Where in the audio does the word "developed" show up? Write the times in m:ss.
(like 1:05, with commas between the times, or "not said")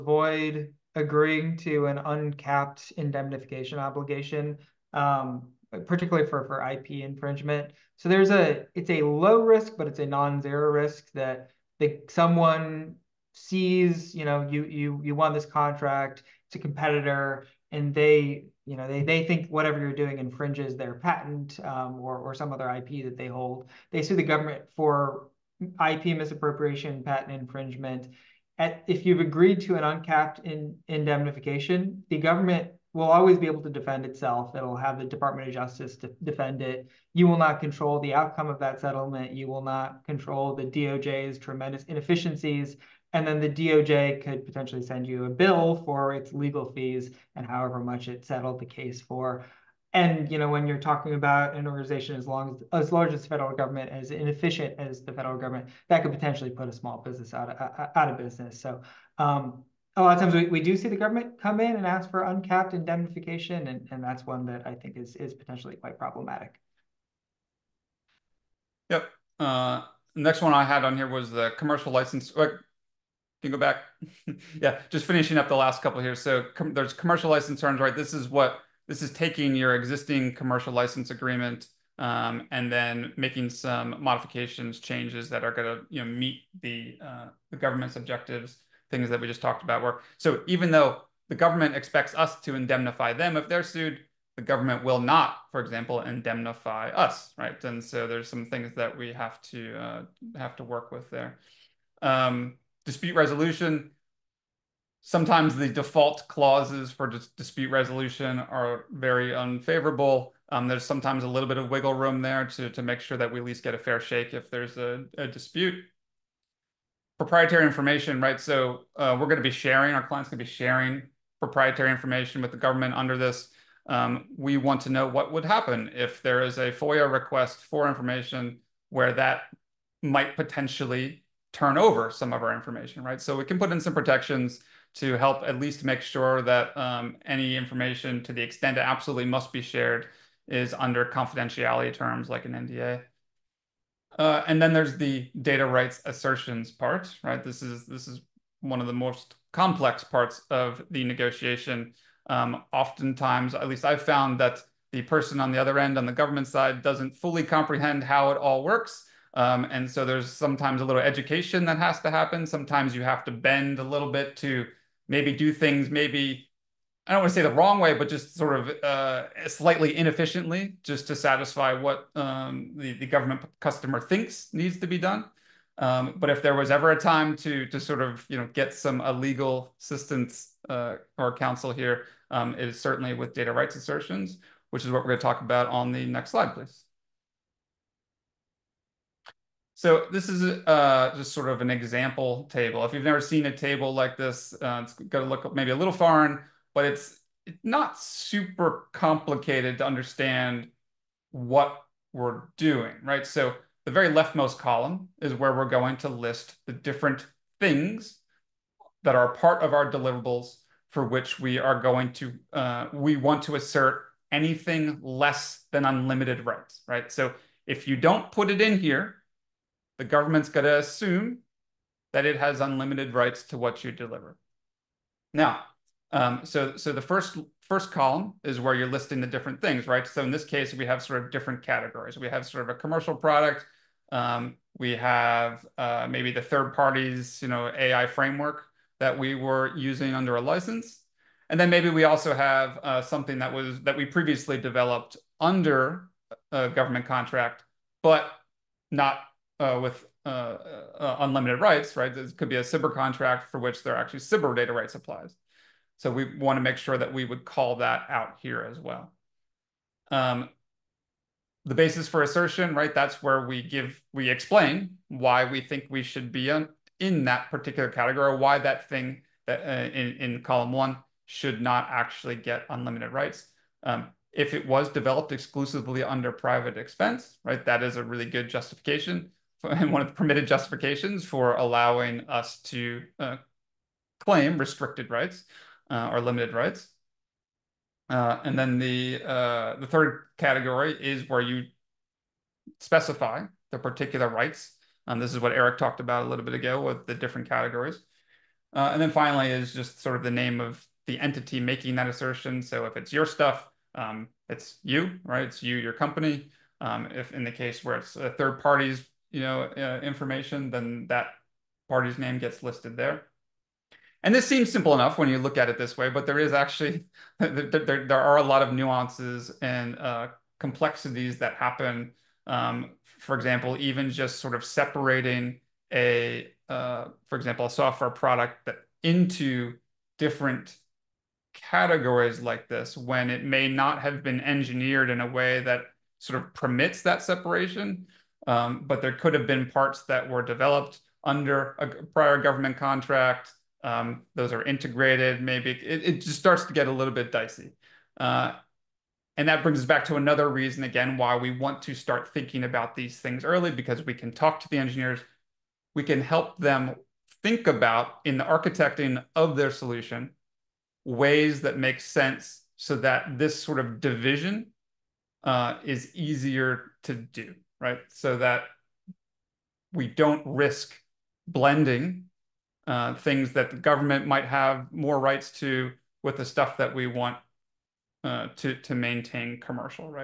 4:04, 4:34, 5:40.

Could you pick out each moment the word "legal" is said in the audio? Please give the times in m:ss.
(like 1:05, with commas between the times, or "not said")
0:46, 2:59.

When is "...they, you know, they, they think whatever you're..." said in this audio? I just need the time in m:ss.
0:17.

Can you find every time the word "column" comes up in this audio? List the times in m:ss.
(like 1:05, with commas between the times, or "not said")
3:24, 3:47, 4:30.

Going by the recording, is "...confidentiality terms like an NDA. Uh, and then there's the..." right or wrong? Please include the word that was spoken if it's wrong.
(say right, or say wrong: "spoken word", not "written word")
right.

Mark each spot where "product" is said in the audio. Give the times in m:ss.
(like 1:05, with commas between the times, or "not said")
3:53, 5:28.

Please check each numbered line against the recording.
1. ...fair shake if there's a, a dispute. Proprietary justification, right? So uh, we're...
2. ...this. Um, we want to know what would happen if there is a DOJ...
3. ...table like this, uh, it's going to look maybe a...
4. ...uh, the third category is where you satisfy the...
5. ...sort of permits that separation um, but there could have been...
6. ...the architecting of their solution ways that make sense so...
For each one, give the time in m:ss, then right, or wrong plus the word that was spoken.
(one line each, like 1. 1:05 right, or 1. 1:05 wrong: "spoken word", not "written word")
1. 1:53 wrong: "information", not "justification"
2. 2:03 wrong: "FOIA", not "DOJ"
3. 3:13 right
4. 4:49 wrong: "specify", not "satisfy"
5. 5:36 right
6. 5:58 right.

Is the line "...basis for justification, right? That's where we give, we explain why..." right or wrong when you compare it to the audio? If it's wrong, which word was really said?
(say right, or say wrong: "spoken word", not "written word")
wrong: "assertion", not "justification".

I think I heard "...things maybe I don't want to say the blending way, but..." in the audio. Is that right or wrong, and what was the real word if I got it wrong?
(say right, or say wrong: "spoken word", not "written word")
wrong: "wrong", not "blending".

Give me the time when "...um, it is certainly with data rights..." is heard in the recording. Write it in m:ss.
3:02.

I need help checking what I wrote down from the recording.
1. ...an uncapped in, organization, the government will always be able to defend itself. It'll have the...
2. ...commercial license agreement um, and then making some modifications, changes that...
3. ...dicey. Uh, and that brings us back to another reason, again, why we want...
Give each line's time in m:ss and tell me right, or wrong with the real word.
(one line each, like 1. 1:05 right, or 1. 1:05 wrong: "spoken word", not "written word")
1. 0:29 wrong: "indemnification", not "organization"
2. 1:20 right
3. 5:47 right.